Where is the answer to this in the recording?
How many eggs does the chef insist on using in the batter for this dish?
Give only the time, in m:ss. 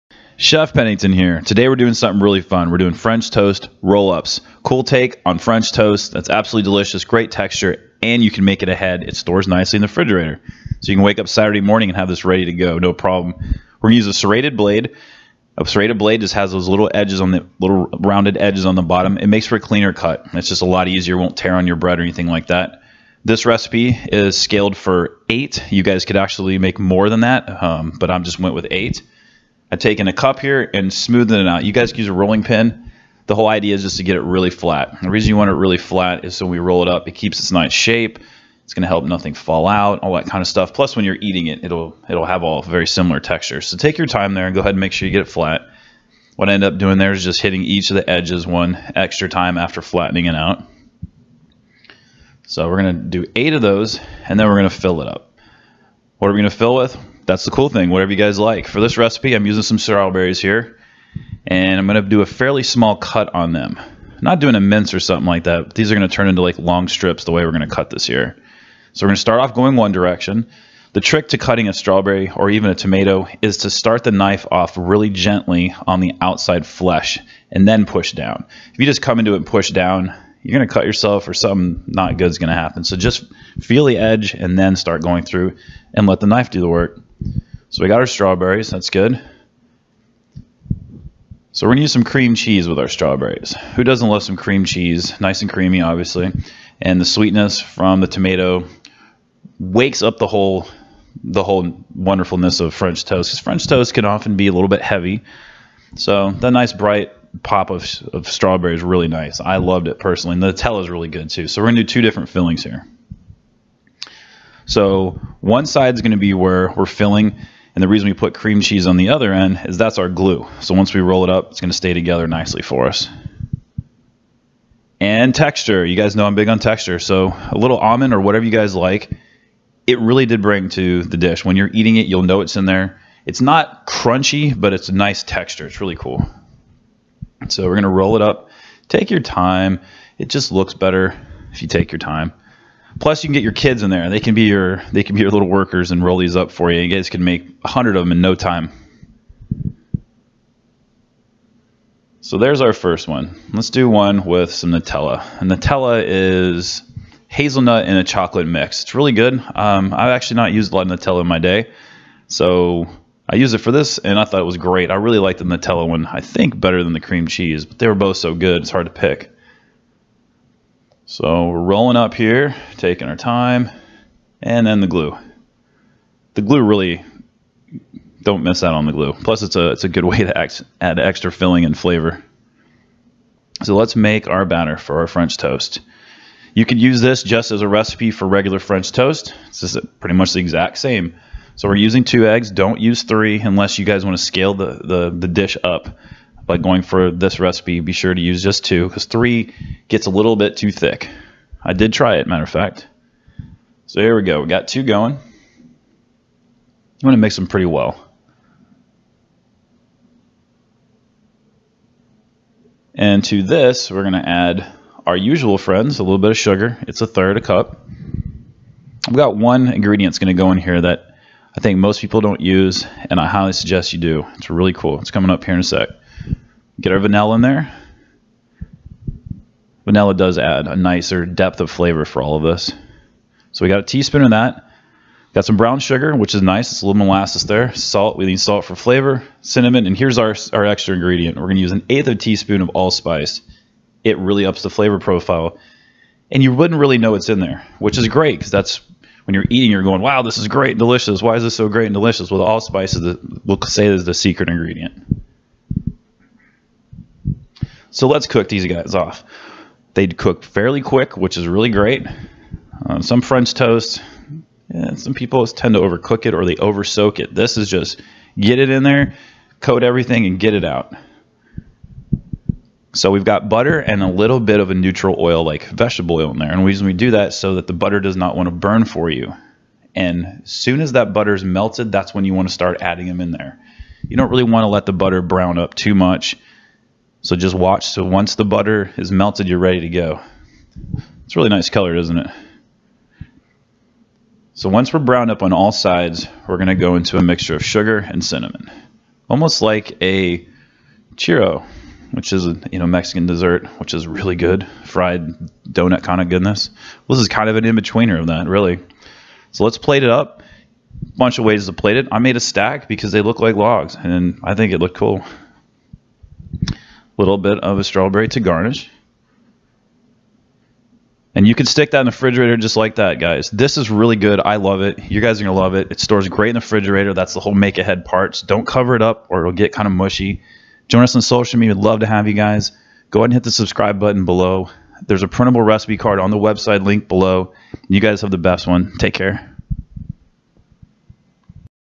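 3:12.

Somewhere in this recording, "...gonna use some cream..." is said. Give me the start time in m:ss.
1:31.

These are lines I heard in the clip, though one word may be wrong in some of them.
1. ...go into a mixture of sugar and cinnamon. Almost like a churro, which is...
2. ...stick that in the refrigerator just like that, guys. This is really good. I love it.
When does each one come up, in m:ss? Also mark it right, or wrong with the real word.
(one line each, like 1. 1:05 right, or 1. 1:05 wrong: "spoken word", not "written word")
1. 4:56 right
2. 5:21 right.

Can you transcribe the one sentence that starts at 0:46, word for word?
What I end up doing there is just hitting each of the edges one extra time after flattening it out.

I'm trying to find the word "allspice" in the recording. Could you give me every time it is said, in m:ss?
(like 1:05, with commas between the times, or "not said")
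4:02, 4:12.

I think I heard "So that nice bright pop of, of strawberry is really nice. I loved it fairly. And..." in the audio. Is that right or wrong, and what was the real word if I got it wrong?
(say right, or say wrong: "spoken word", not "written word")
wrong: "personally", not "fairly".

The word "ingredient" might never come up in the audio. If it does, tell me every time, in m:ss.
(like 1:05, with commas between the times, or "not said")
3:39, 4:00, 4:14.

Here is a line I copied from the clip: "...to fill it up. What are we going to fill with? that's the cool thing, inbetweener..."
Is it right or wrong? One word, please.
wrong.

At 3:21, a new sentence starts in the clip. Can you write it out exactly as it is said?
I did try it, matter of fact.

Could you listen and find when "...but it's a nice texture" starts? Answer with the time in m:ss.
2:14.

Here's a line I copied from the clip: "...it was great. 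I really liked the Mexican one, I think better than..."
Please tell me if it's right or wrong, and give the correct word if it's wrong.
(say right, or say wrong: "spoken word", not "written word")
wrong: "Nutella", not "Mexican".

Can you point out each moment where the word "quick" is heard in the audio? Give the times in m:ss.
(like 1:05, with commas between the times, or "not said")
4:20.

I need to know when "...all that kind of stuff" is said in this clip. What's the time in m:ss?
0:39.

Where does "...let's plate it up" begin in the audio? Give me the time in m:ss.
5:09.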